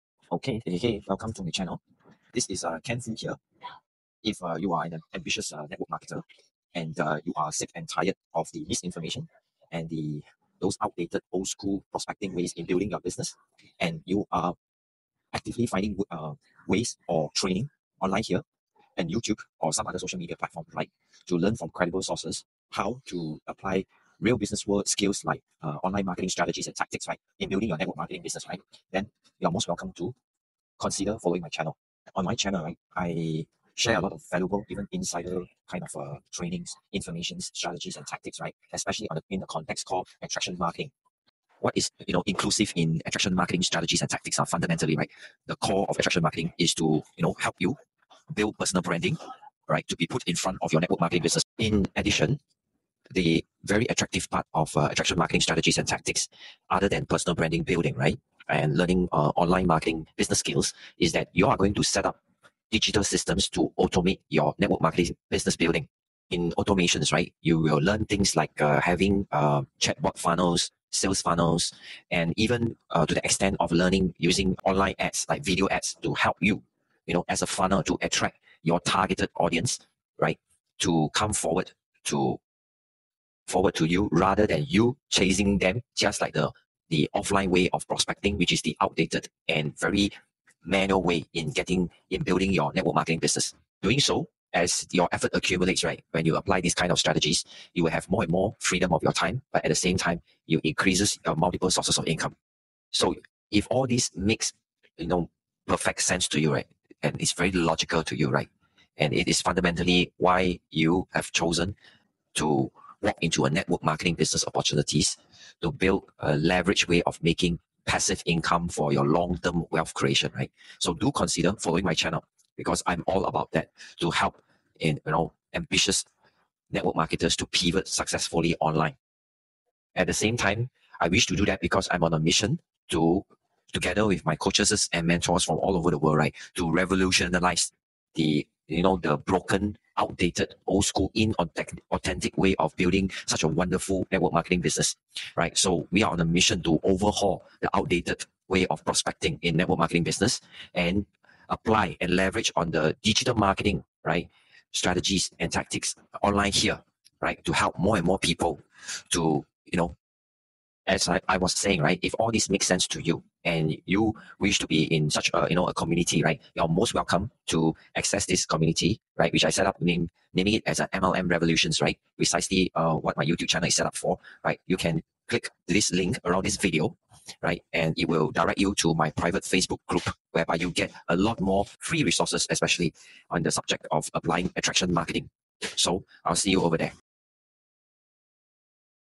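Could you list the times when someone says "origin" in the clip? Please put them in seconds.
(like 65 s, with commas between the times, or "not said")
not said.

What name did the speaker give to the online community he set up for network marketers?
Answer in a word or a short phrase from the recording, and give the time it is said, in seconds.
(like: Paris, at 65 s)
MLM Revolutions, at 170 s.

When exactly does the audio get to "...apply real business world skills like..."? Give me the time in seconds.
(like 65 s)
23 s.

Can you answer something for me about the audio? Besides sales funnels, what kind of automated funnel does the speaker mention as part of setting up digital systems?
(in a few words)
Chatbot funnels.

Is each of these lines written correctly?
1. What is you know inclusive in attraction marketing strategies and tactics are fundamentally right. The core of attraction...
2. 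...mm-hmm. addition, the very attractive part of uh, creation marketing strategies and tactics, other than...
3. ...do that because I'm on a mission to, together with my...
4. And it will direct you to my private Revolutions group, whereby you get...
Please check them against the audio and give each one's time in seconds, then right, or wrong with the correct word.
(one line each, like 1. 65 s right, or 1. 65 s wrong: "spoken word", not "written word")
1. 41 s right
2. 51 s wrong: "attraction", not "creation"
3. 131 s right
4. 177 s wrong: "Facebook", not "Revolutions".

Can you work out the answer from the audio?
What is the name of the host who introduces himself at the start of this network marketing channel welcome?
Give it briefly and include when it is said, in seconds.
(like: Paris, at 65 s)
Ken Foo, at 2 s.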